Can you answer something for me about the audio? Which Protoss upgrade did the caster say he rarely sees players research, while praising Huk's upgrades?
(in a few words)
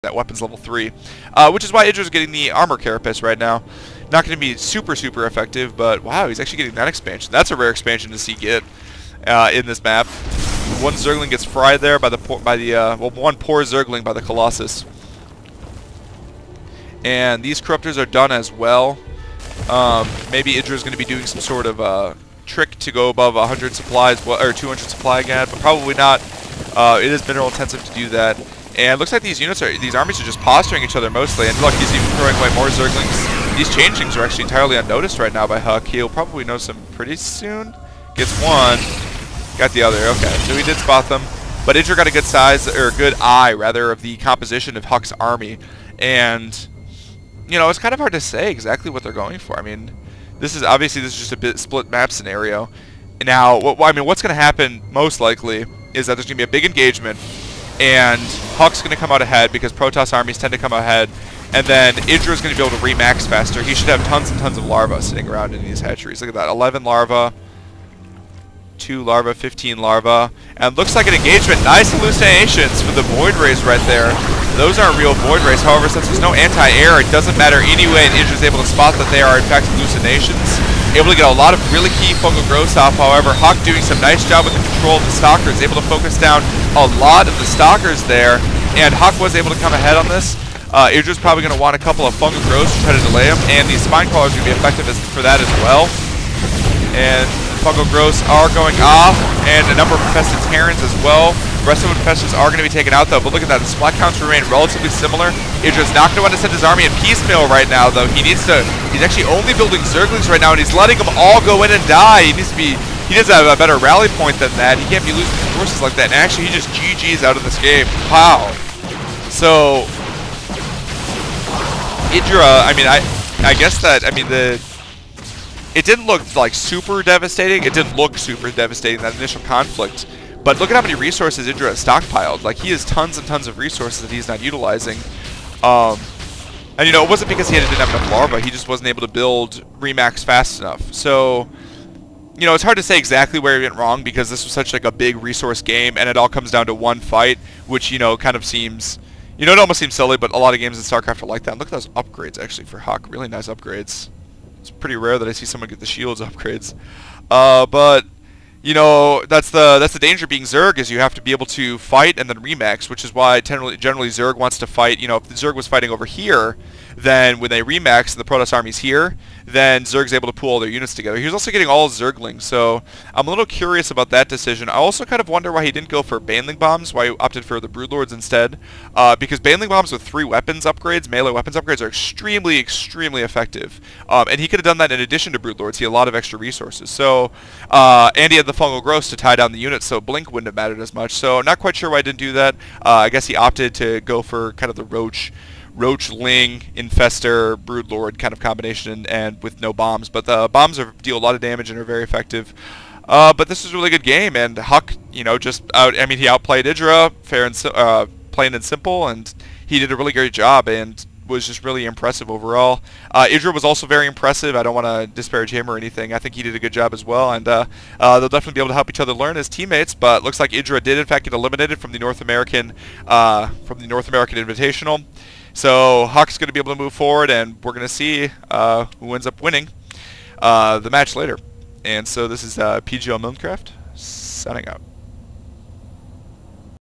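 Shields upgrades.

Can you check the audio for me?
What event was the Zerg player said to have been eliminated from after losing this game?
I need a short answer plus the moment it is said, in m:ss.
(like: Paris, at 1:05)
North American Invitational, at 3:43.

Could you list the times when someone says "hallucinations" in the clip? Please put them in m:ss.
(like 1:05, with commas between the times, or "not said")
1:11, 1:19.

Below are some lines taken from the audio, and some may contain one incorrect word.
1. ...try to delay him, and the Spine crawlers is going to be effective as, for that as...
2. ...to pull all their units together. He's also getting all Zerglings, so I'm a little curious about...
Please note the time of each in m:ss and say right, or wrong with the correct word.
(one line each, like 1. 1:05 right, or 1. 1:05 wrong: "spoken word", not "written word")
1. 1:32 right
2. 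2:50 right.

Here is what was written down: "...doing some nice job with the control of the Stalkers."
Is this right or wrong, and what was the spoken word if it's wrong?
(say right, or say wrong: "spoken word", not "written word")
right.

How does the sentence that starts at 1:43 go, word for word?
The splat counts remain relatively similar.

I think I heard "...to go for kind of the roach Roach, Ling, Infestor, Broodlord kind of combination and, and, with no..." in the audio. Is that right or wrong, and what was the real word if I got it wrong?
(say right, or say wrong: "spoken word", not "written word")
right.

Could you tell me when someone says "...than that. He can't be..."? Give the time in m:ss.
1:54.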